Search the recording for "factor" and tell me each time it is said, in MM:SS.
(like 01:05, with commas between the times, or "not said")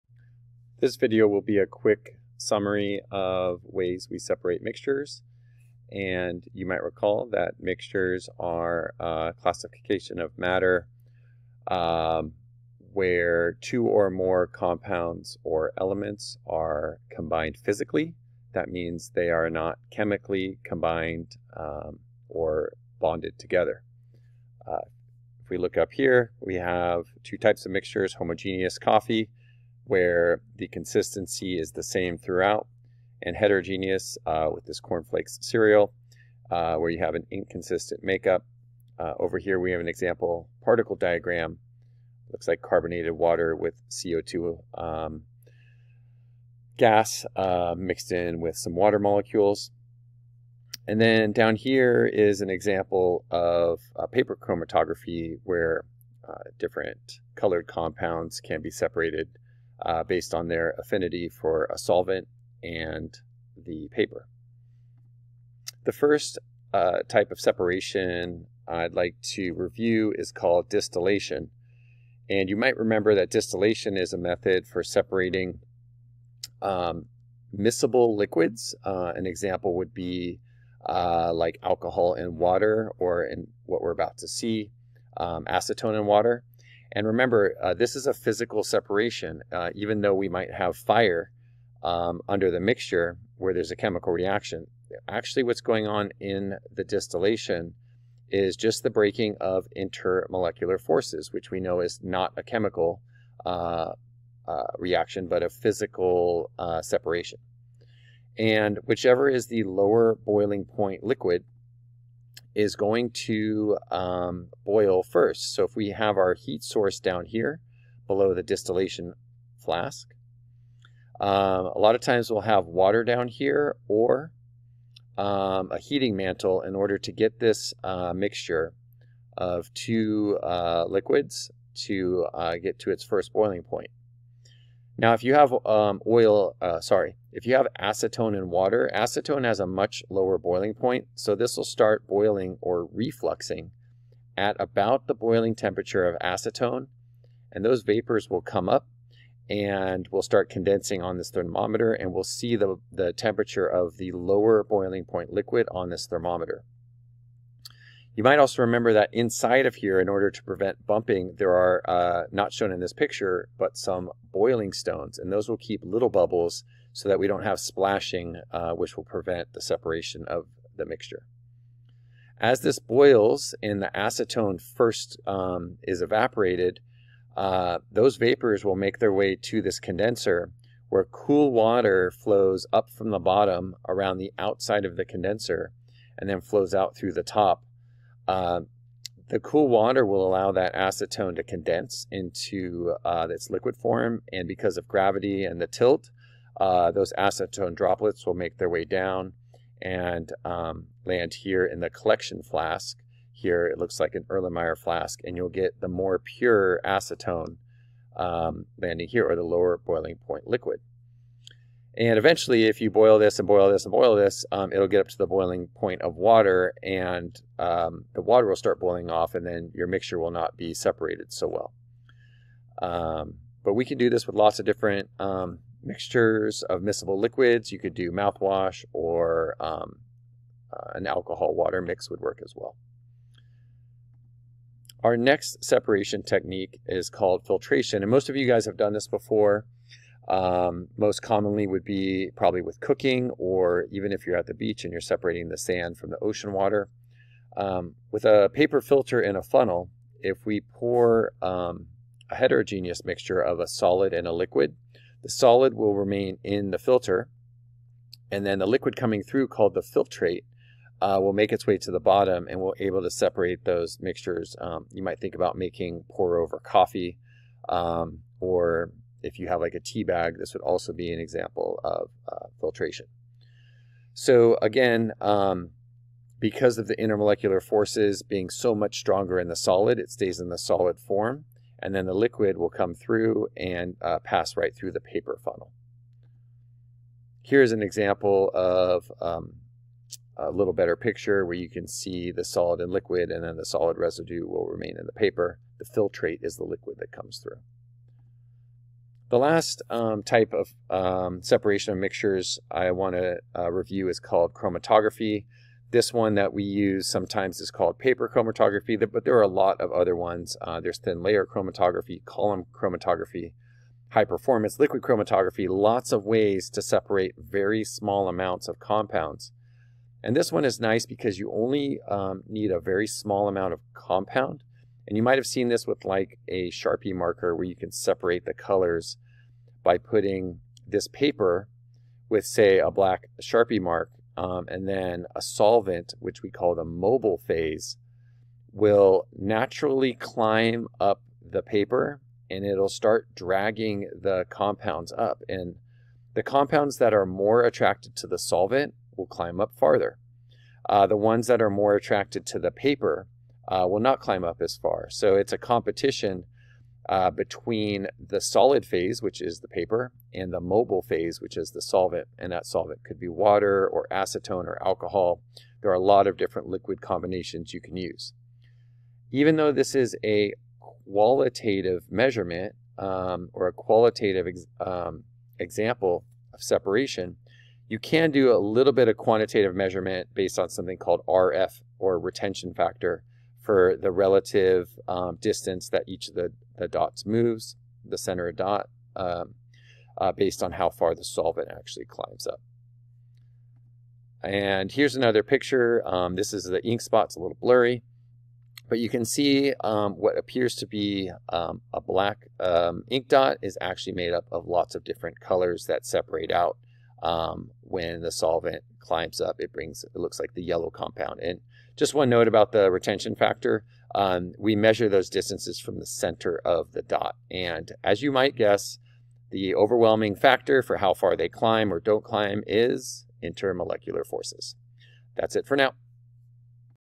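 06:22, 06:53, 07:00.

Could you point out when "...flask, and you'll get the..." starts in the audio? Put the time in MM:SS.
03:24.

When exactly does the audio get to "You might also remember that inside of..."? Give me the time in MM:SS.
02:38.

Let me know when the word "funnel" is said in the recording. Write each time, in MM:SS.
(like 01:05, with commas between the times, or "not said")
04:09, 04:45.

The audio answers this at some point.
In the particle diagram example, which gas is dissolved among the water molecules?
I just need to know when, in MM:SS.
00:43.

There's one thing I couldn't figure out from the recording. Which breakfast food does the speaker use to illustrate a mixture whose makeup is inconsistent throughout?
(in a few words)
cornflakes cereal.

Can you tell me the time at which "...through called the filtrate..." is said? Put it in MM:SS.
04:19.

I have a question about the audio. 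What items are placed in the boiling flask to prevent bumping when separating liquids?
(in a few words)
boiling stones.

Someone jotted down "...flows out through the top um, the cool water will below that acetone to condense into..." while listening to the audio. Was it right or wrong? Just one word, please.
wrong.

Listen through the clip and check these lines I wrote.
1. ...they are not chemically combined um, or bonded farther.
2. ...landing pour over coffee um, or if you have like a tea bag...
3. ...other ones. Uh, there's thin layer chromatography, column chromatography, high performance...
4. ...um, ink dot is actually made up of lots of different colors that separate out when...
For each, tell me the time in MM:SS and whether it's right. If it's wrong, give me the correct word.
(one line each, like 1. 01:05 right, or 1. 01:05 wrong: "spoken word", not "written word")
1. 00:19 wrong: "together", not "farther"
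2. 04:25 wrong: "making", not "landing"
3. 05:09 right
4. 06:42 right.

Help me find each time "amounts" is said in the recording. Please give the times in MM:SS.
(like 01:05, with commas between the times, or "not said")
05:18, 05:23.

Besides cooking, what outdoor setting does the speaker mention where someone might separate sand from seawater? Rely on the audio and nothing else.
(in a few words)
the beach.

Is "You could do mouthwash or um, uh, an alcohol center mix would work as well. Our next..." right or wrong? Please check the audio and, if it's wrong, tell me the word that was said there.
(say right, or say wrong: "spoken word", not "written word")
wrong: "water", not "center".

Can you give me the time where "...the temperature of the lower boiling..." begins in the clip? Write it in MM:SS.
02:32.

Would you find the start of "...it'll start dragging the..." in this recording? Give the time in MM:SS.
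05:42.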